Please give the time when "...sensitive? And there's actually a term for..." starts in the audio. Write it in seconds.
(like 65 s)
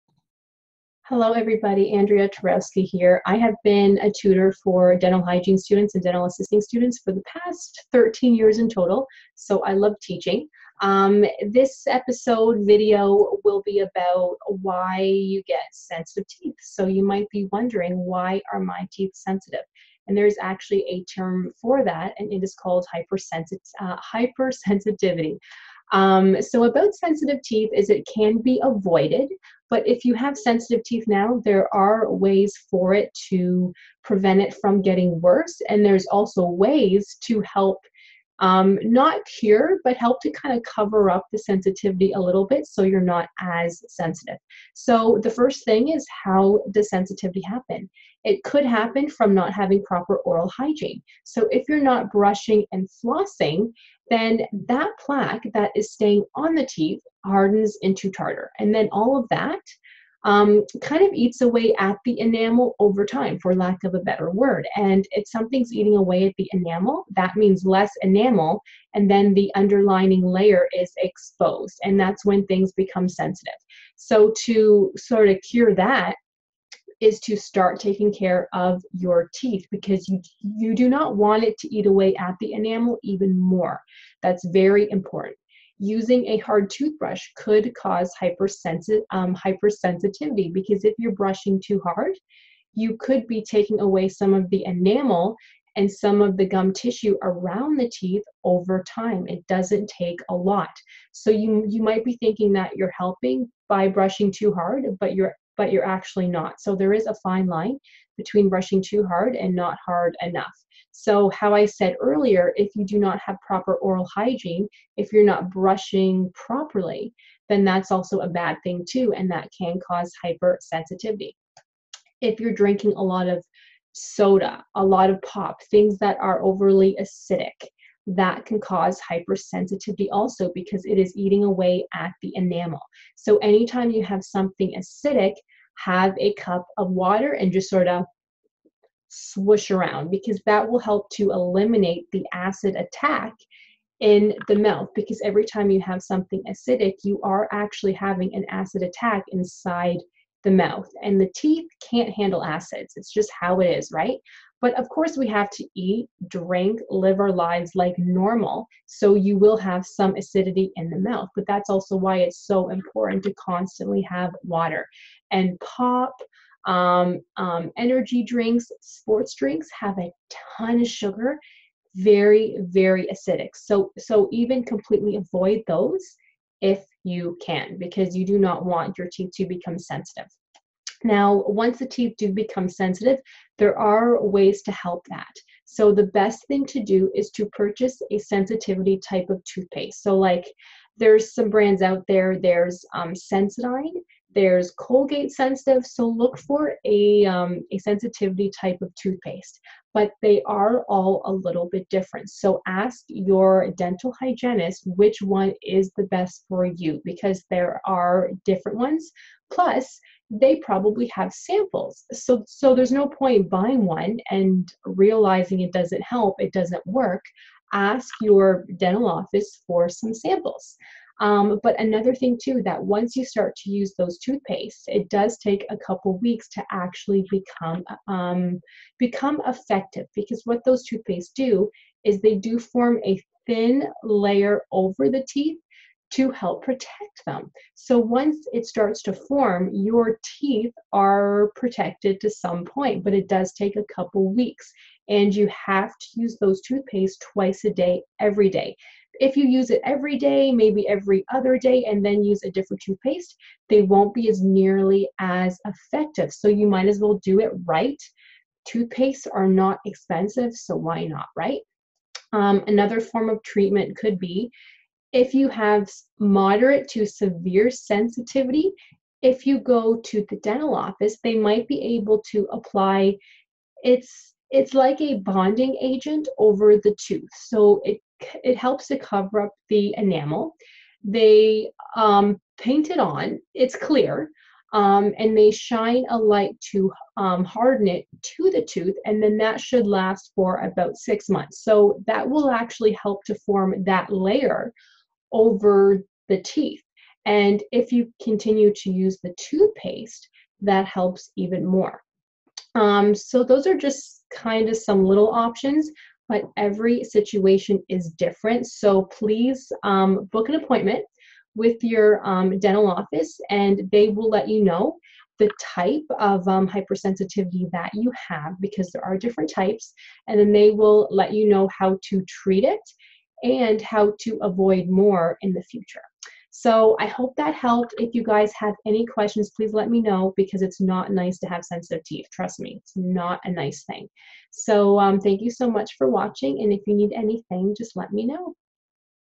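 19 s.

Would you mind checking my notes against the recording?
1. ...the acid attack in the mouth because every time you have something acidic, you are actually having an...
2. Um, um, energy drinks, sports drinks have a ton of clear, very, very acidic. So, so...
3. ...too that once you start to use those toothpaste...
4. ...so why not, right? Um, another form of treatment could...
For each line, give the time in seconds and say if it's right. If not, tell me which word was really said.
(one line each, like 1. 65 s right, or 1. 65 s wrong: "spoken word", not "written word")
1. 142 s right
2. 166 s wrong: "sugar", not "clear"
3. 222 s right
4. 260 s right.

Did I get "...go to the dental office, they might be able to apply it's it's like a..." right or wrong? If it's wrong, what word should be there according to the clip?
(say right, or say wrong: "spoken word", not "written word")
right.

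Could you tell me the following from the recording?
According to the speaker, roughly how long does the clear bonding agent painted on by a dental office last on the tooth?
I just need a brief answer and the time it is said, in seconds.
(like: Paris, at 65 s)
6 months, at 290 s.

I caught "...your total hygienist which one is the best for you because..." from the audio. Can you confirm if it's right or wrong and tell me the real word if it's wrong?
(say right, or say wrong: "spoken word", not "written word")
wrong: "dental", not "total".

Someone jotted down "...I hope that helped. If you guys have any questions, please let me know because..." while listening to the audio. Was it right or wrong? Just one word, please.
right.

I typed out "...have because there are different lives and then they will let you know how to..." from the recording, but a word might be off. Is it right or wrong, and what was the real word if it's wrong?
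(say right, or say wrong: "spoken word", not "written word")
wrong: "types", not "lives".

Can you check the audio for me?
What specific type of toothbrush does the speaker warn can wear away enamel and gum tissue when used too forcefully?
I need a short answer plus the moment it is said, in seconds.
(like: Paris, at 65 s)
hard toothbrush, at 86 s.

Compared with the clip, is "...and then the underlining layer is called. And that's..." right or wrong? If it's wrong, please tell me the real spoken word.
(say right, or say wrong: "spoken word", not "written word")
wrong: "exposed", not "called".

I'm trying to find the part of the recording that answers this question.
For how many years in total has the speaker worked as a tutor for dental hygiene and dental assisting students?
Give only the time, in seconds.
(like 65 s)
7 s.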